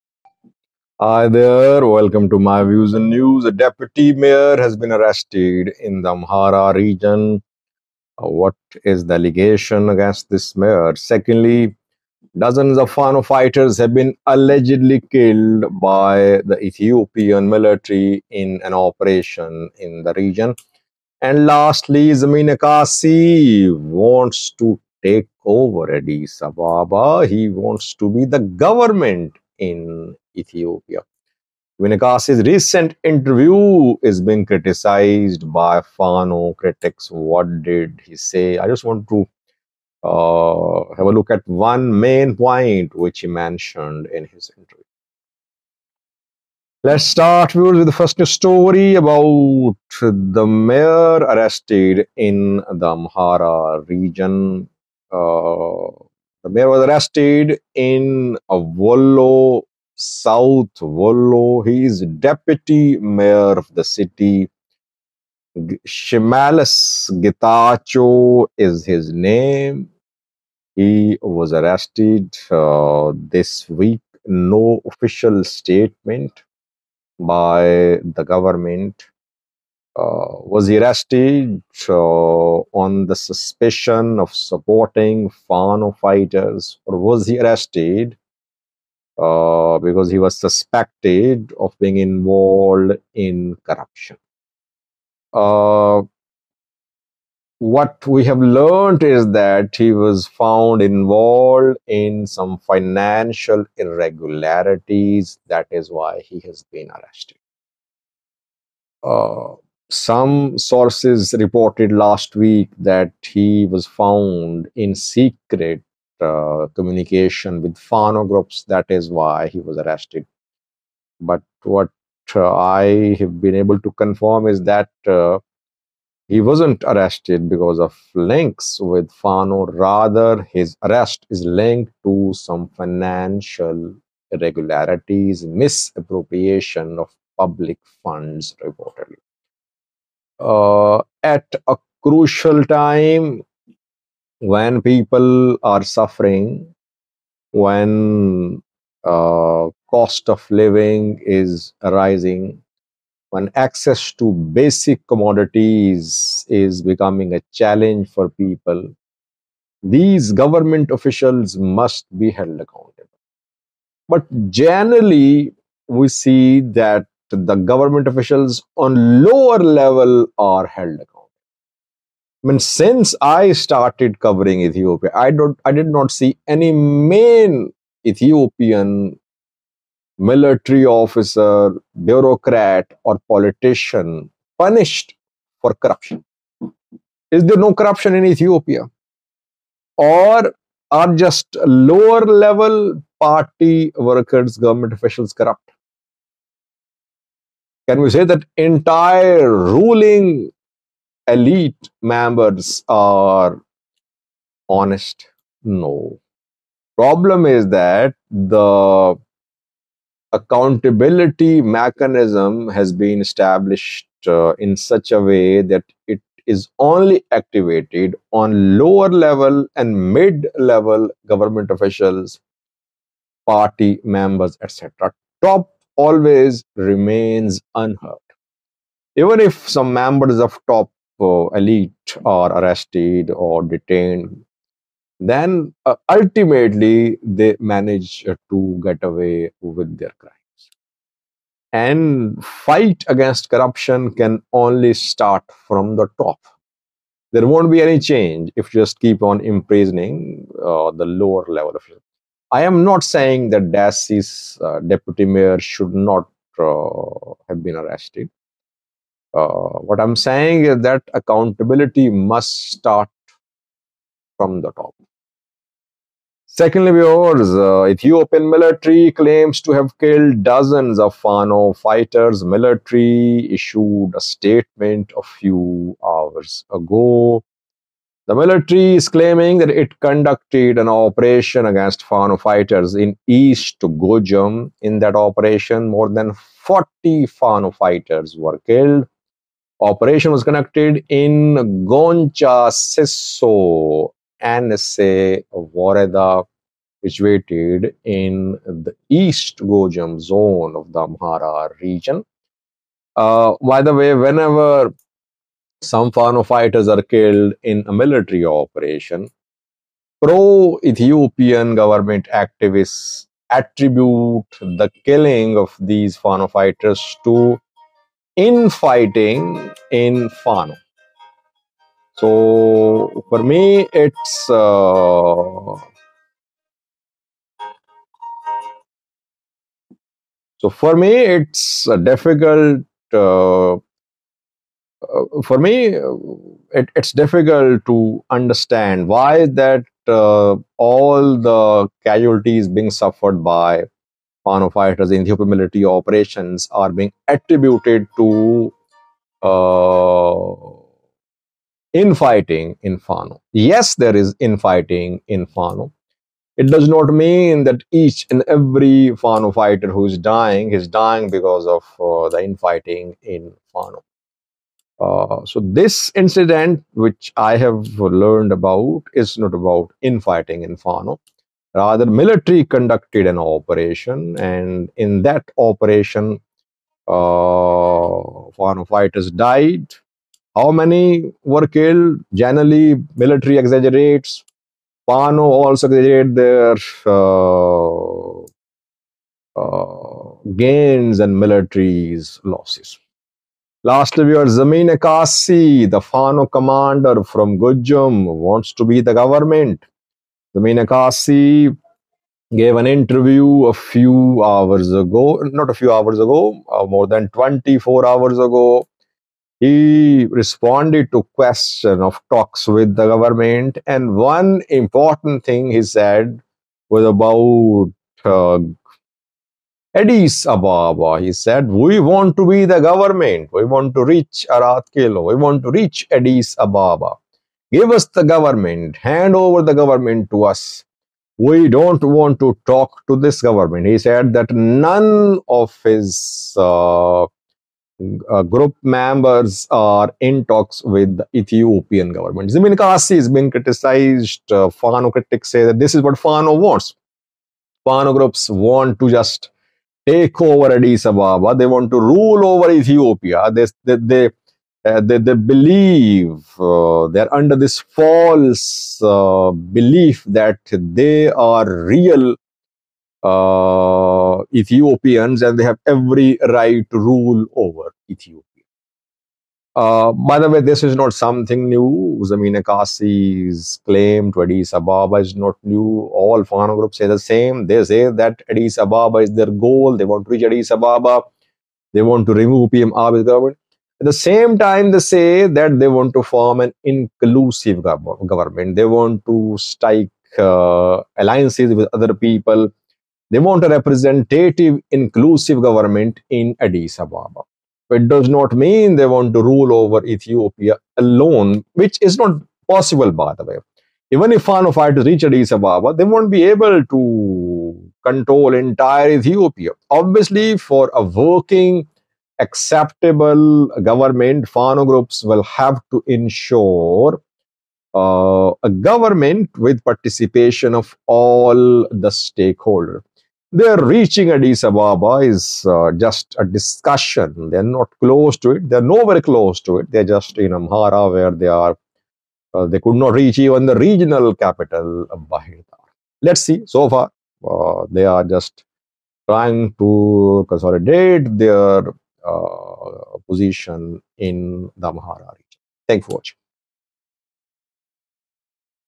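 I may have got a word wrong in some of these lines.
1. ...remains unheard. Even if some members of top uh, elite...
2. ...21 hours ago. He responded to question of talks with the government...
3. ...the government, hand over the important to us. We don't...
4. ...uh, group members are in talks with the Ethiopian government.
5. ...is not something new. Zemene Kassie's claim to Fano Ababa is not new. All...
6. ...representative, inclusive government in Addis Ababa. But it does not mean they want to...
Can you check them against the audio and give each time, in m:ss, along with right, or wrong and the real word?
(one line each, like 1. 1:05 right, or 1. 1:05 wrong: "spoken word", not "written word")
1. 3:46 right
2. 6:47 wrong: "24", not "21"
3. 7:08 wrong: "government", not "important"
4. 7:17 right
5. 7:50 wrong: "Addis", not "Fano"
6. 8:13 right.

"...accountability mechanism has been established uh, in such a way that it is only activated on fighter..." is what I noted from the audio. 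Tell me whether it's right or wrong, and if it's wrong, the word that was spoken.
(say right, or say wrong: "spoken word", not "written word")
wrong: "lower", not "fighter".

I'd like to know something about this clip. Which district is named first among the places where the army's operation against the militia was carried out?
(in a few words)
Goncha.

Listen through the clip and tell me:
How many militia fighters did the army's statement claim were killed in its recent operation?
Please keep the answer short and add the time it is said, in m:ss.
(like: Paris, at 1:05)
More than 40, at 4:45.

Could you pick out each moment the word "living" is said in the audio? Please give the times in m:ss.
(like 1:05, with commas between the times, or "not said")
2:30.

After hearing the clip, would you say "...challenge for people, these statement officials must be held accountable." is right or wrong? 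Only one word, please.
wrong.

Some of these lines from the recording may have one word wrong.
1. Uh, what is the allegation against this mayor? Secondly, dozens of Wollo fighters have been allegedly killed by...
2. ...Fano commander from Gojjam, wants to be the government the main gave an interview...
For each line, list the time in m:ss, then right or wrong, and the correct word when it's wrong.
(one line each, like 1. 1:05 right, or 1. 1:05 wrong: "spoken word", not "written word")
1. 0:08 wrong: "Fano", not "Wollo"
2. 6:36 right.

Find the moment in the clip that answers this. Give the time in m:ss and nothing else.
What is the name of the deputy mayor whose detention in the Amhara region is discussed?
1:05.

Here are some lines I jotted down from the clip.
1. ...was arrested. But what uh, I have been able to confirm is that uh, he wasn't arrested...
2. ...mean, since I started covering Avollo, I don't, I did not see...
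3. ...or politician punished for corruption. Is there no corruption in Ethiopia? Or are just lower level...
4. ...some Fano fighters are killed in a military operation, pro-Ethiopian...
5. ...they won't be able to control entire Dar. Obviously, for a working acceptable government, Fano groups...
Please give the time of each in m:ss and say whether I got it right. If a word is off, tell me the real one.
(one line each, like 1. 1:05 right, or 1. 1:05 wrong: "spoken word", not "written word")
1. 1:59 right
2. 2:52 wrong: "Ethiopia", not "Avollo"
3. 3:03 right
4. 5:05 right
5. 8:25 wrong: "Ethiopia", not "Dar".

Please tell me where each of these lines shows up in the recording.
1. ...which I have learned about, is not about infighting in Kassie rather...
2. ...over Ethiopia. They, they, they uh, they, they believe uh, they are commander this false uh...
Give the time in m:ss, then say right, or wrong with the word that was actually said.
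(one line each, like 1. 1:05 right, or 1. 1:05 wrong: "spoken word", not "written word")
1. 6:06 wrong: "Fano", not "Kassie"
2. 7:32 wrong: "under", not "commander".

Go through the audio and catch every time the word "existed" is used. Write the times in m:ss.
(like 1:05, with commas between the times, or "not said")
not said.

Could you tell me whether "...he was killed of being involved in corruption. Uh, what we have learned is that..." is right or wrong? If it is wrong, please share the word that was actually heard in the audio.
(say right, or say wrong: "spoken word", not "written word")
wrong: "suspected", not "killed".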